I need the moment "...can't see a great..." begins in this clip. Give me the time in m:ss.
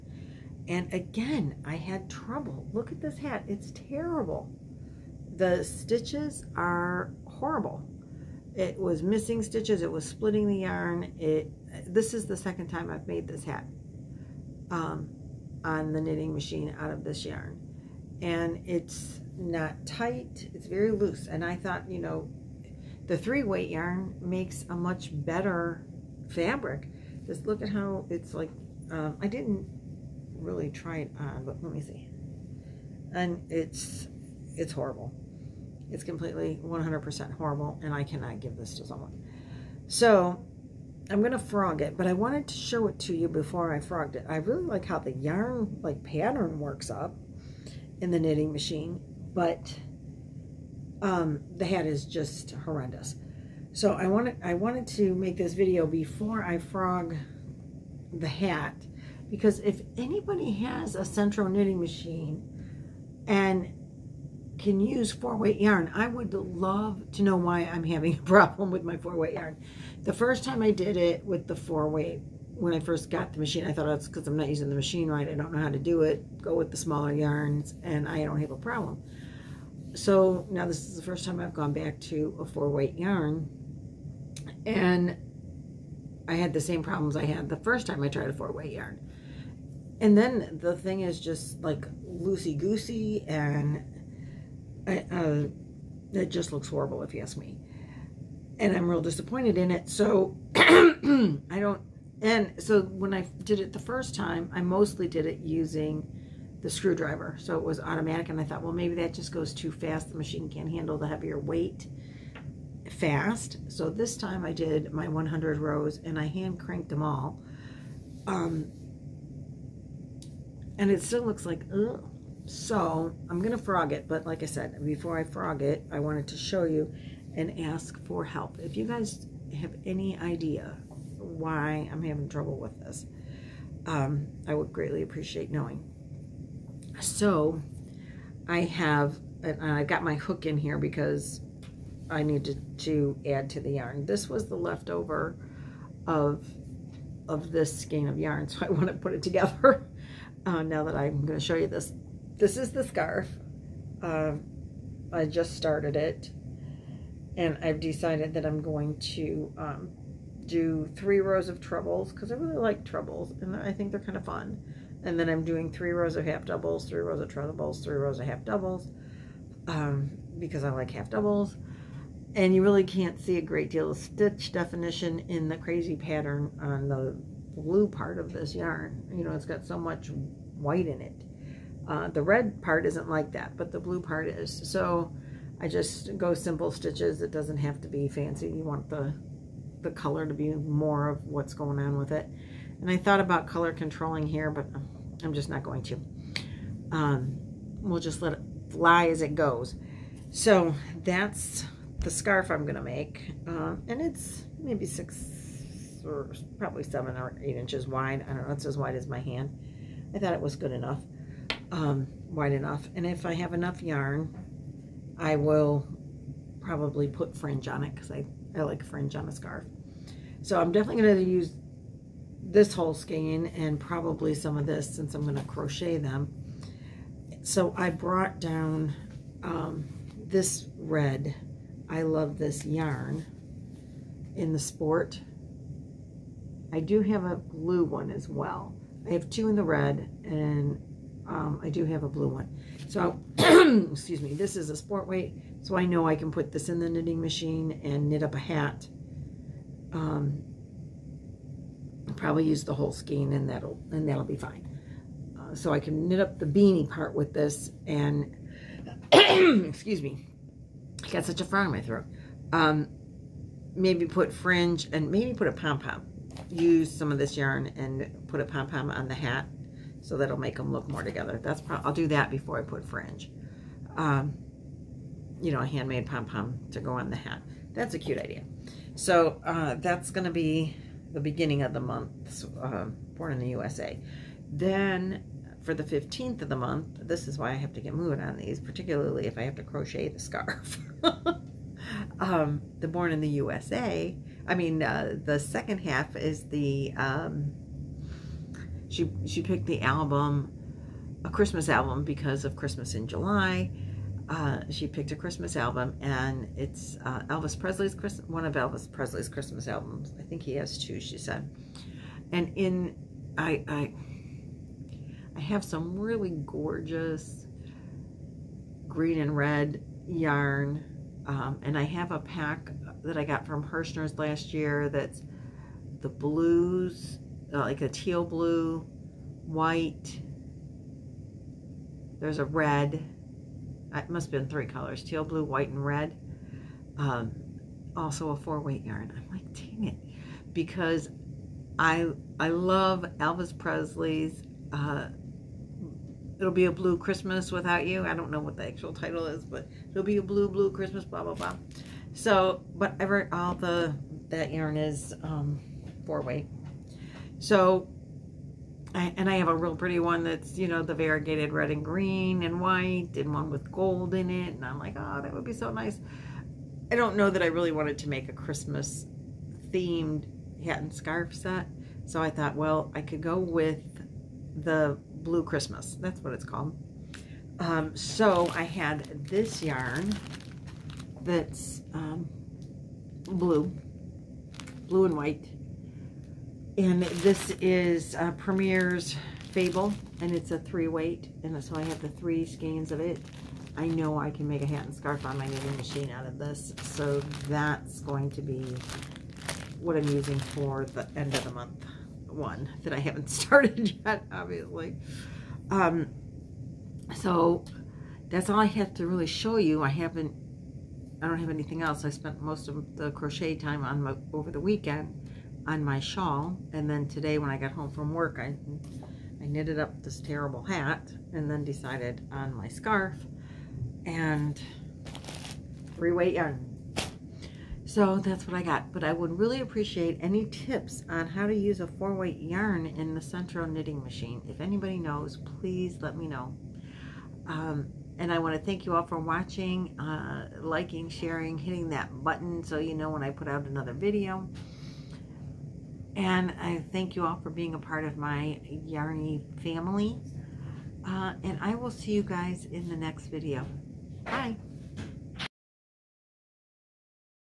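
2:52.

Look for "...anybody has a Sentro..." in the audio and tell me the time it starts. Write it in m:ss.
0:59.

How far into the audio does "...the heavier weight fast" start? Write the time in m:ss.
1:50.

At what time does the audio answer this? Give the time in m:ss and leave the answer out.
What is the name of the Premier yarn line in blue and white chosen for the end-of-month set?
6:29.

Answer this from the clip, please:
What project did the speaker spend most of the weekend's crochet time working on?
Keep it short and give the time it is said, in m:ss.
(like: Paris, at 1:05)
Shawl, at 6:55.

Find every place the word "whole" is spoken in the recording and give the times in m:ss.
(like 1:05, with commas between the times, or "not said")
3:42, 4:12.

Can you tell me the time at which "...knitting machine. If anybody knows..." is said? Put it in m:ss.
7:13.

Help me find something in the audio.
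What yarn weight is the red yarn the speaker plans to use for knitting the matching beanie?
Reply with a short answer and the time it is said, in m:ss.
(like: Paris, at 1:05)
Sport weight, at 4:04.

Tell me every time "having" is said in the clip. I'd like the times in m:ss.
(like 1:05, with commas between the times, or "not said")
1:07, 2:12.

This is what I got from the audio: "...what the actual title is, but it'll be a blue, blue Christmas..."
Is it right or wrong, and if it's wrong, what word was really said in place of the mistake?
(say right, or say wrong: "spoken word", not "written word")
right.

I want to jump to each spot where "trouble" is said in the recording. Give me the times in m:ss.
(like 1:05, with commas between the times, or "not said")
0:02, 2:12.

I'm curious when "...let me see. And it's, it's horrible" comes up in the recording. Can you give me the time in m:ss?
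0:31.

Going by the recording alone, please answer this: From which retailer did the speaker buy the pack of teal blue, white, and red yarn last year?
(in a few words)
Herrschners.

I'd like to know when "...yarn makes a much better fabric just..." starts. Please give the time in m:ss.
0:23.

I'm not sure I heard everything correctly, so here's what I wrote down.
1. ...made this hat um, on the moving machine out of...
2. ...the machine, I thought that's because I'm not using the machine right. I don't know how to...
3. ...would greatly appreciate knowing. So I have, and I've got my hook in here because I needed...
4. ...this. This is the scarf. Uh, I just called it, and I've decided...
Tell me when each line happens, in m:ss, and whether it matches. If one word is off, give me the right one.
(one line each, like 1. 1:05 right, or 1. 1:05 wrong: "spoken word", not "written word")
1. 0:13 wrong: "knitting", not "moving"
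2. 1:13 right
3. 2:14 right
4. 2:31 wrong: "started", not "called".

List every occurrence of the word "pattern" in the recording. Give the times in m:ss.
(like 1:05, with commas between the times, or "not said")
0:46, 2:55.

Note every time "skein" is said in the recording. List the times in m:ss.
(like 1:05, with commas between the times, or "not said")
2:27, 3:42, 4:12, 6:32.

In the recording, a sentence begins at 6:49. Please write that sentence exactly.
I haven't, I don't have anything else.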